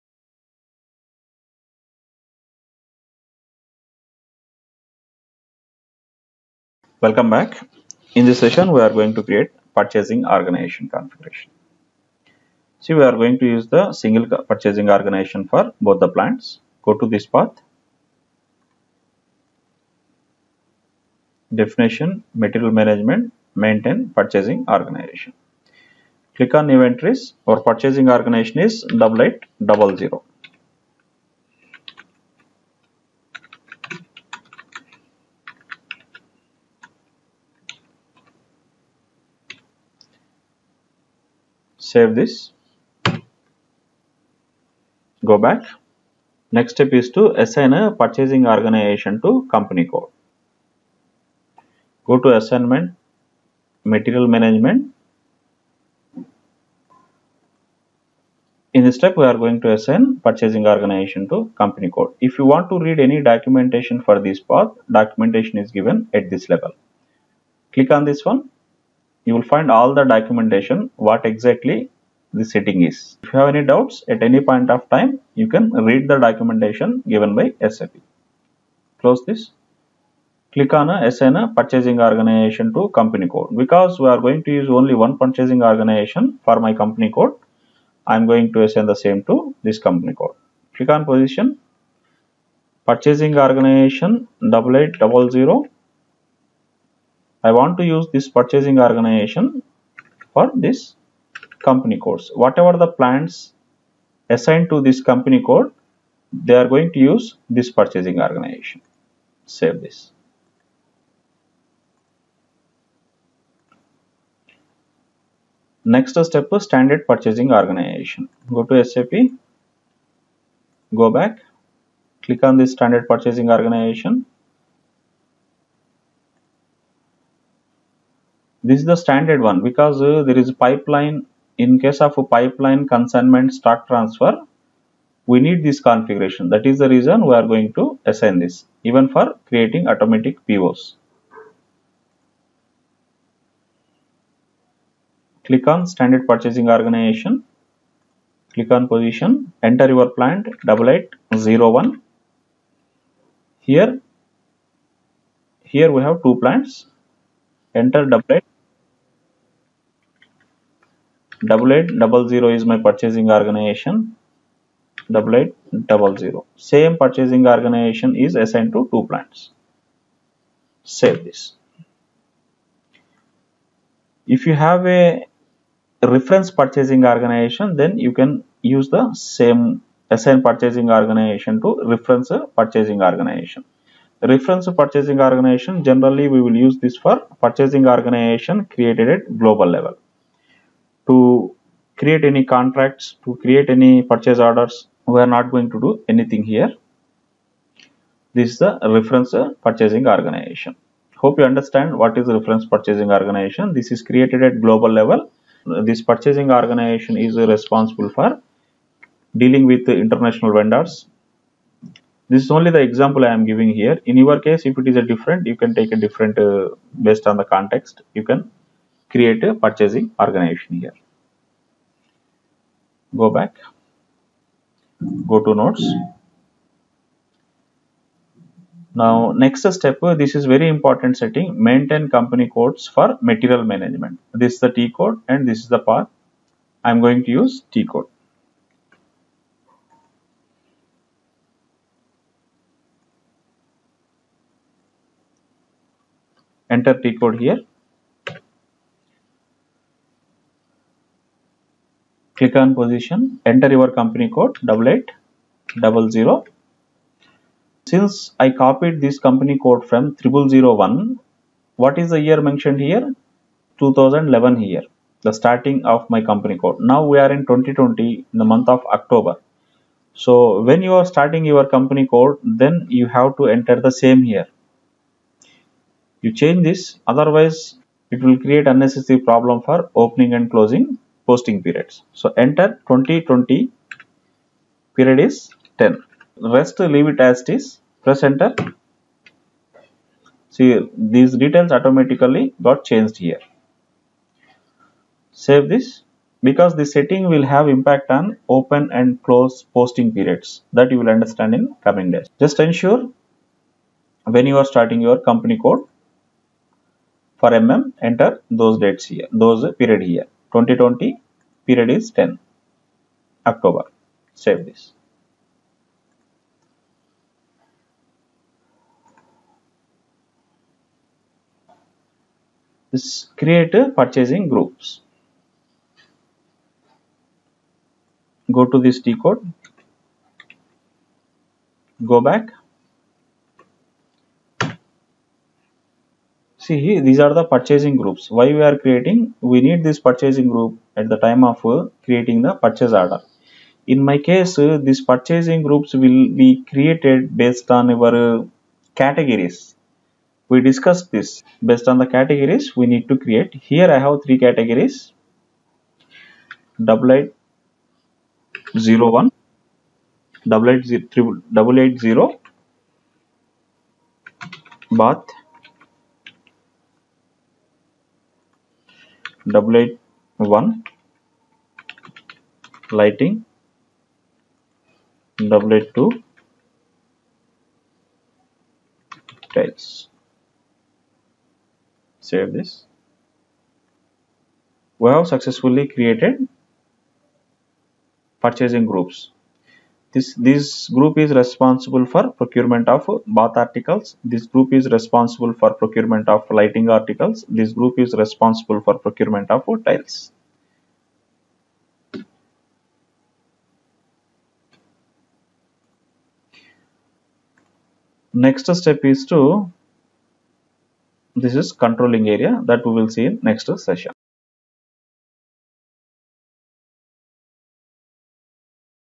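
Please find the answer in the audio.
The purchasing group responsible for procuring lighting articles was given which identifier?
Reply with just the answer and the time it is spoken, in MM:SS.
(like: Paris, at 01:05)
8810, at 06:09.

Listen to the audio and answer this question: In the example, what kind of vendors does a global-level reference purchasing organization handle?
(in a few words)
international vendors.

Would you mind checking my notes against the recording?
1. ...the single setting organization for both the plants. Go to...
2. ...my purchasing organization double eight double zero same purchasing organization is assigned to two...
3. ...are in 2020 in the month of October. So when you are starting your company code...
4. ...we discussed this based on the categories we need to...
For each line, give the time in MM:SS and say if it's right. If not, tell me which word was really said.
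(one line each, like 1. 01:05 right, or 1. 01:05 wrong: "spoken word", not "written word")
1. 00:13 wrong: "purchasing", not "setting"
2. 02:42 right
3. 04:27 right
4. 05:50 right.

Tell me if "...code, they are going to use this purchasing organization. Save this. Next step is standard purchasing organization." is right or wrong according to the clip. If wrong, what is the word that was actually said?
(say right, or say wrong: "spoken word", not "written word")
right.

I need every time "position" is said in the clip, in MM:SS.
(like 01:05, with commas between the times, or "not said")
01:31, 02:28, 04:12.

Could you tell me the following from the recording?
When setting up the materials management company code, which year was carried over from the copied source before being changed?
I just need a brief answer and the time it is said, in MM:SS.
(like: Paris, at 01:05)
2011, at 04:23.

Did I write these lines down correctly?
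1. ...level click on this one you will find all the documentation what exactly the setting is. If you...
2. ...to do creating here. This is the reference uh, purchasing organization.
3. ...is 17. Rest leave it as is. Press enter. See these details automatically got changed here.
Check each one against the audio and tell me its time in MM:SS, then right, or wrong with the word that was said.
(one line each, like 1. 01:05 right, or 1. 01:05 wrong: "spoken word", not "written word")
1. 01:06 right
2. 03:15 wrong: "anything", not "creating"
3. 04:45 wrong: "10", not "17".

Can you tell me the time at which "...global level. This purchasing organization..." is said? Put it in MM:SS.
03:24.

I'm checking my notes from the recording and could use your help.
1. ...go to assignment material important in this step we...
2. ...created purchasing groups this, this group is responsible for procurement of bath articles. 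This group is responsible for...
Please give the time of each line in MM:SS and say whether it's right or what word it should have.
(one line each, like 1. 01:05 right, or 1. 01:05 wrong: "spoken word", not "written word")
1. 00:52 wrong: "management", not "important"
2. 06:25 right.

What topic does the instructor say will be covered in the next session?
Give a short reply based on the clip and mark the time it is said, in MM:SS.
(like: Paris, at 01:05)
controlling area, at 06:51.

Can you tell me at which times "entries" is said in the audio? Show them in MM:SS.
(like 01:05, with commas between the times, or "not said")
00:26.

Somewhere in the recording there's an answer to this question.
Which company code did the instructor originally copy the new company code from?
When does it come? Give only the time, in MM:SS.
04:20.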